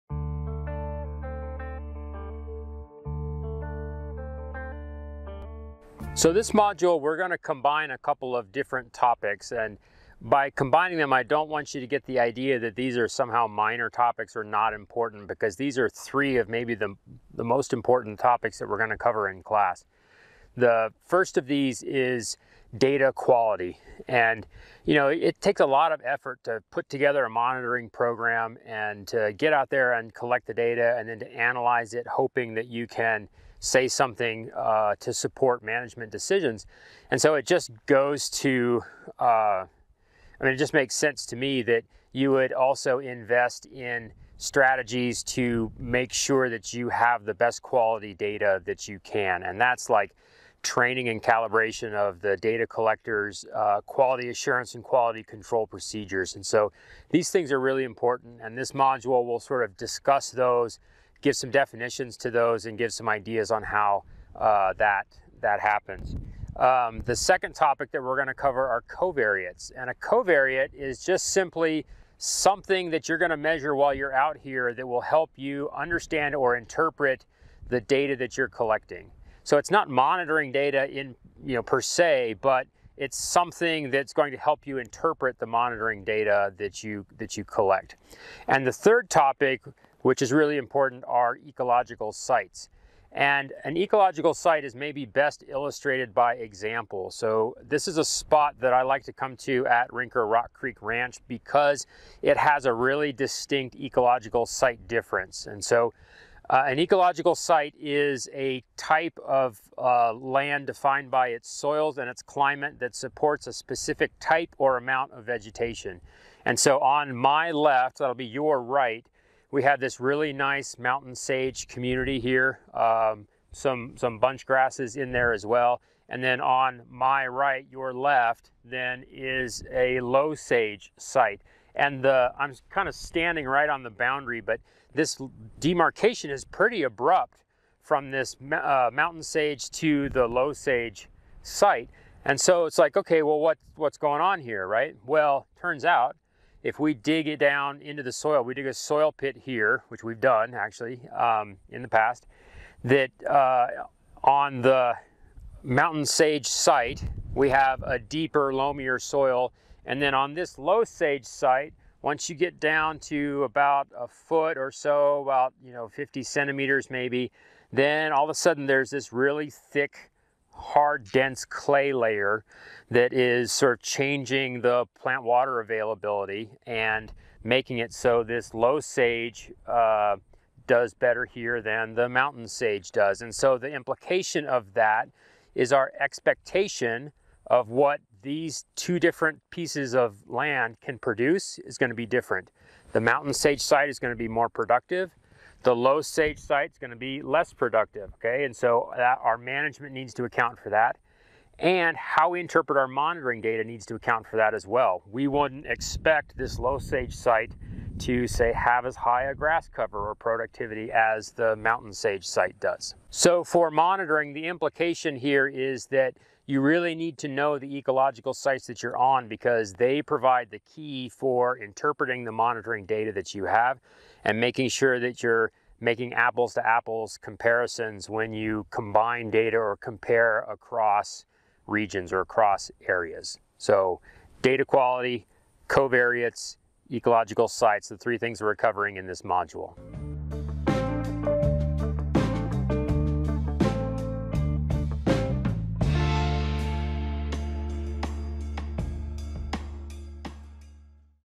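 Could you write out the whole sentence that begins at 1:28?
And the third topic which is really important, are ecological sites.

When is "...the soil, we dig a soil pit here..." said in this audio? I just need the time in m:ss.
2:28.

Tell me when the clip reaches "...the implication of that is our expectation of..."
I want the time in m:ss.
3:03.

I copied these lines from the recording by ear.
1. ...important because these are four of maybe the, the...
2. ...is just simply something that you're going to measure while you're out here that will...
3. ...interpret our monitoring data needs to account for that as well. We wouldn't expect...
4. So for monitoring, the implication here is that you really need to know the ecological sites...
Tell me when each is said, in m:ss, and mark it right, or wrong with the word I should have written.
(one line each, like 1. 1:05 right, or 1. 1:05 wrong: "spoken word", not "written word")
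1. 0:14 wrong: "three", not "four"
2. 1:10 right
3. 3:22 right
4. 3:33 right.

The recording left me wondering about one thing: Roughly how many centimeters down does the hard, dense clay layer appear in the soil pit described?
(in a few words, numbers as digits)
50.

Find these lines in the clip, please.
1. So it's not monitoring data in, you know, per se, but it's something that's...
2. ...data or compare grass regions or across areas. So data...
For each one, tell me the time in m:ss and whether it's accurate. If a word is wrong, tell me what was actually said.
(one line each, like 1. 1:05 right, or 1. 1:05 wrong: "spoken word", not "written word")
1. 1:19 right
2. 3:49 wrong: "across", not "grass".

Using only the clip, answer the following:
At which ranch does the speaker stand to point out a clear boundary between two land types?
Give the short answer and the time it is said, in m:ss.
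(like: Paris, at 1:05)
Rinker Rock Creek Ranch, at 1:39.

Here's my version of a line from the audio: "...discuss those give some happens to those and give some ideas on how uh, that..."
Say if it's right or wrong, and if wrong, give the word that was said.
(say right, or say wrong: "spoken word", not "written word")
wrong: "definitions", not "happens".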